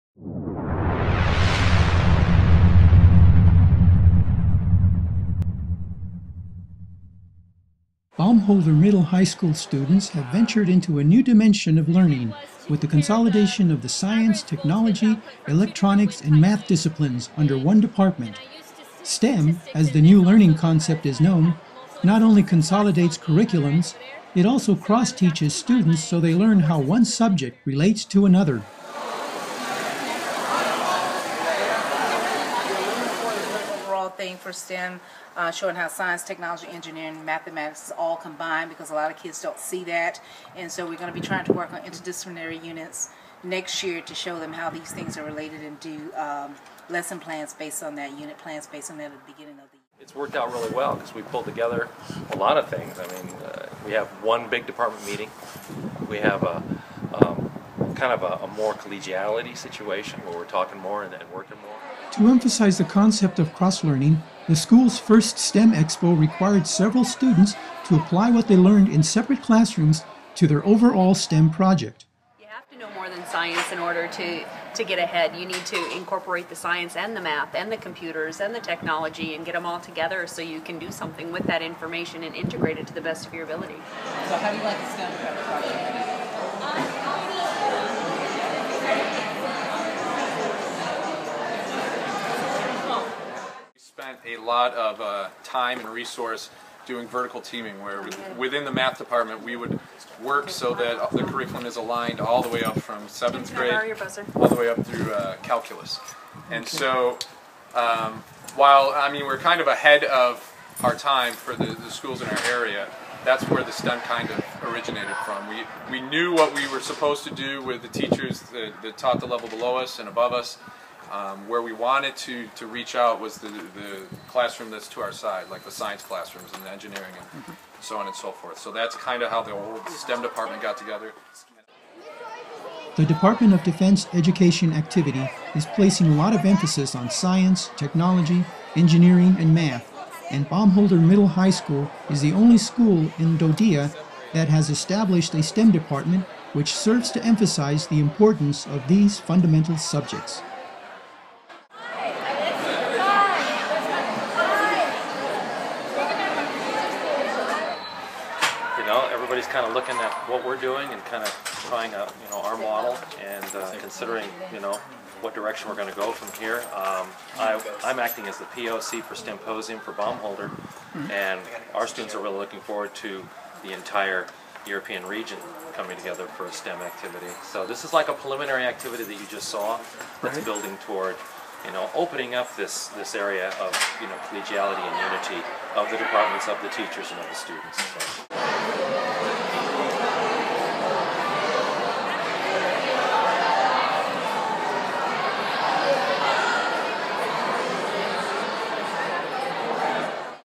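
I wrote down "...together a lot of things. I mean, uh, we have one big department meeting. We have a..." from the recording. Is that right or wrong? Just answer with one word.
right.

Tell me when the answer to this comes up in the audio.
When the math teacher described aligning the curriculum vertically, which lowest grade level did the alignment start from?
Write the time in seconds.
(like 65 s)
103 s.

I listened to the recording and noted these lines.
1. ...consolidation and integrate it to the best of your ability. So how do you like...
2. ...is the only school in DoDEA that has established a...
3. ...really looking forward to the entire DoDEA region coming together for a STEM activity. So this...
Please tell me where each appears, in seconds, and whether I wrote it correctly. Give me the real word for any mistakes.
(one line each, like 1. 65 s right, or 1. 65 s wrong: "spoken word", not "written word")
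1. 81 s wrong: "information", not "consolidation"
2. 142 s right
3. 172 s wrong: "European", not "DoDEA".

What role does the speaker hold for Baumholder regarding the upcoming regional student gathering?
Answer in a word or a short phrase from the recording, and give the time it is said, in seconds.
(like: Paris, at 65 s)
POC for Symposium, at 168 s.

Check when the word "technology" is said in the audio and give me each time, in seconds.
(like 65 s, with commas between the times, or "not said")
14 s, 36 s, 78 s, 137 s.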